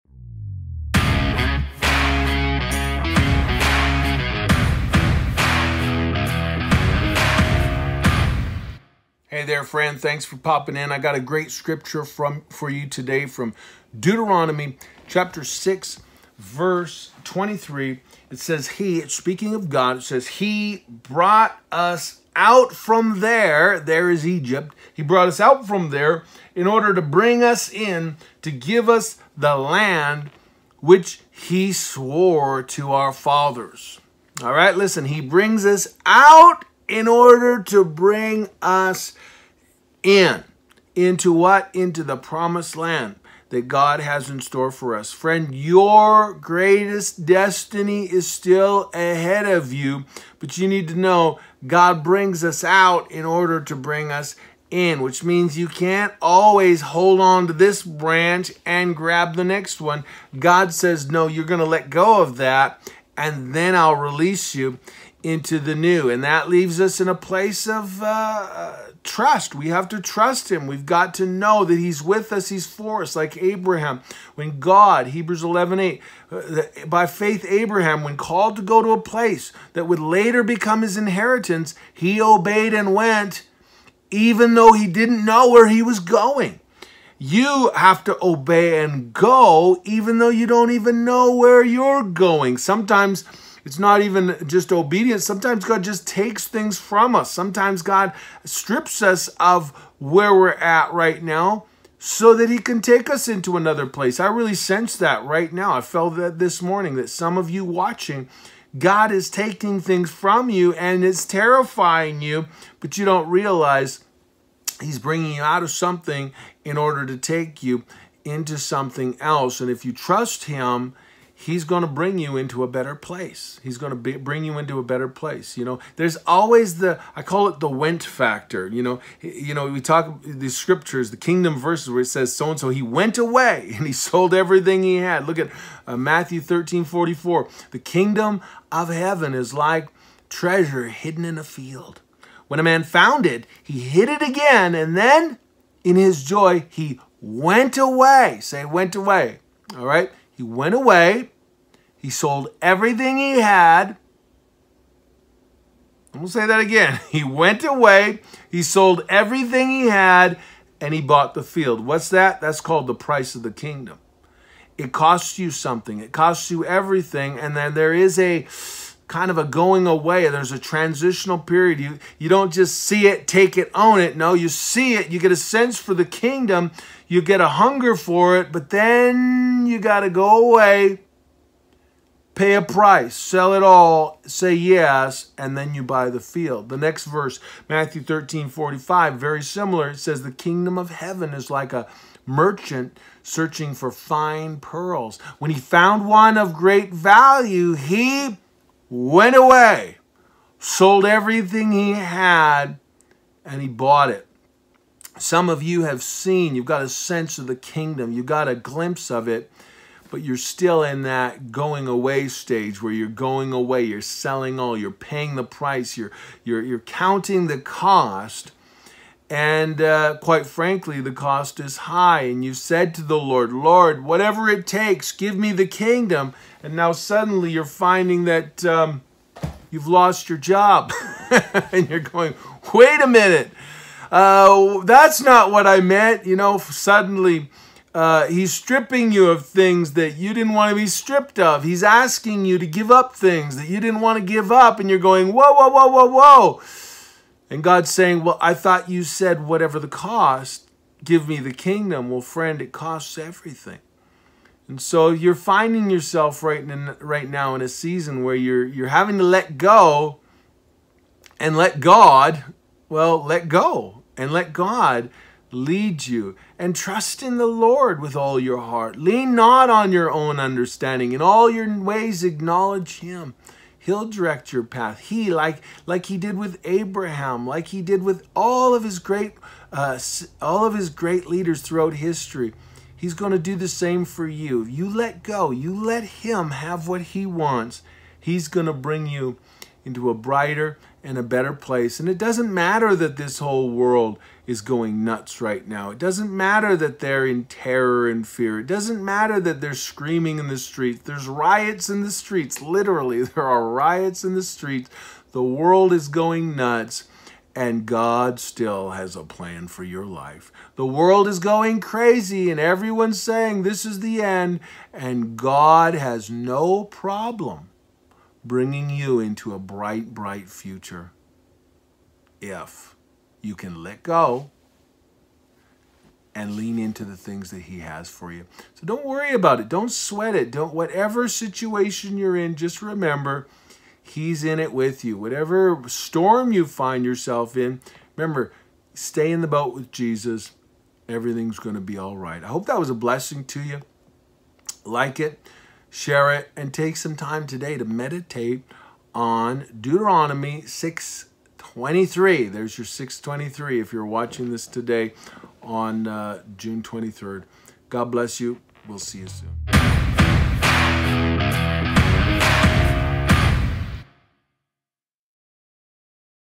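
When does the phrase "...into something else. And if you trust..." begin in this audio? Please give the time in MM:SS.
01:58.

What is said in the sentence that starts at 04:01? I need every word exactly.
He's asking you to give up things that you didn't want to give up.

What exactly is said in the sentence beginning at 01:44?
I really sense that right now.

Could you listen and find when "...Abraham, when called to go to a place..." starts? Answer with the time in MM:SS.
01:17.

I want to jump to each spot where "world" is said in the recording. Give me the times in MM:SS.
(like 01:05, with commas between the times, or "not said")
04:53, 05:05, 05:10.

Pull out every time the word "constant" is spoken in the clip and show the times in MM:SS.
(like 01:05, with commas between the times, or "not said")
not said.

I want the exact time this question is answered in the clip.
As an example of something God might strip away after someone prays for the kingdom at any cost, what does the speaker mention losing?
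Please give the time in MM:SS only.
03:50.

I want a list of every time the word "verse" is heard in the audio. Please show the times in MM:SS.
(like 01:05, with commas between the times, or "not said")
00:16, 02:11, 03:07.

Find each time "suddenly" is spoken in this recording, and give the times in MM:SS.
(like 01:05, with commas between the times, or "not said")
03:46, 03:56.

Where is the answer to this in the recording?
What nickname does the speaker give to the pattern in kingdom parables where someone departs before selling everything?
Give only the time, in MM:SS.
02:07.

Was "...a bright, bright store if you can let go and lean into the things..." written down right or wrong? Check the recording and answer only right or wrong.
wrong.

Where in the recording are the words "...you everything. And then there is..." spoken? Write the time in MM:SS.
02:46.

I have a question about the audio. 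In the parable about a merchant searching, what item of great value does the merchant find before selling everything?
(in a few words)
fine pearls.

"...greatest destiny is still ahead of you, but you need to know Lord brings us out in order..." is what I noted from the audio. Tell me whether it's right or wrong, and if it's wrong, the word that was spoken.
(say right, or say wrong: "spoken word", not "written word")
wrong: "God", not "Lord".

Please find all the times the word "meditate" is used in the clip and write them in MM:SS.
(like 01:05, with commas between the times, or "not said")
05:47.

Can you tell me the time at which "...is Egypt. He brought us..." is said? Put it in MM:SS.
00:24.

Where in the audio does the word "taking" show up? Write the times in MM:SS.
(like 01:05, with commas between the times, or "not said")
01:49.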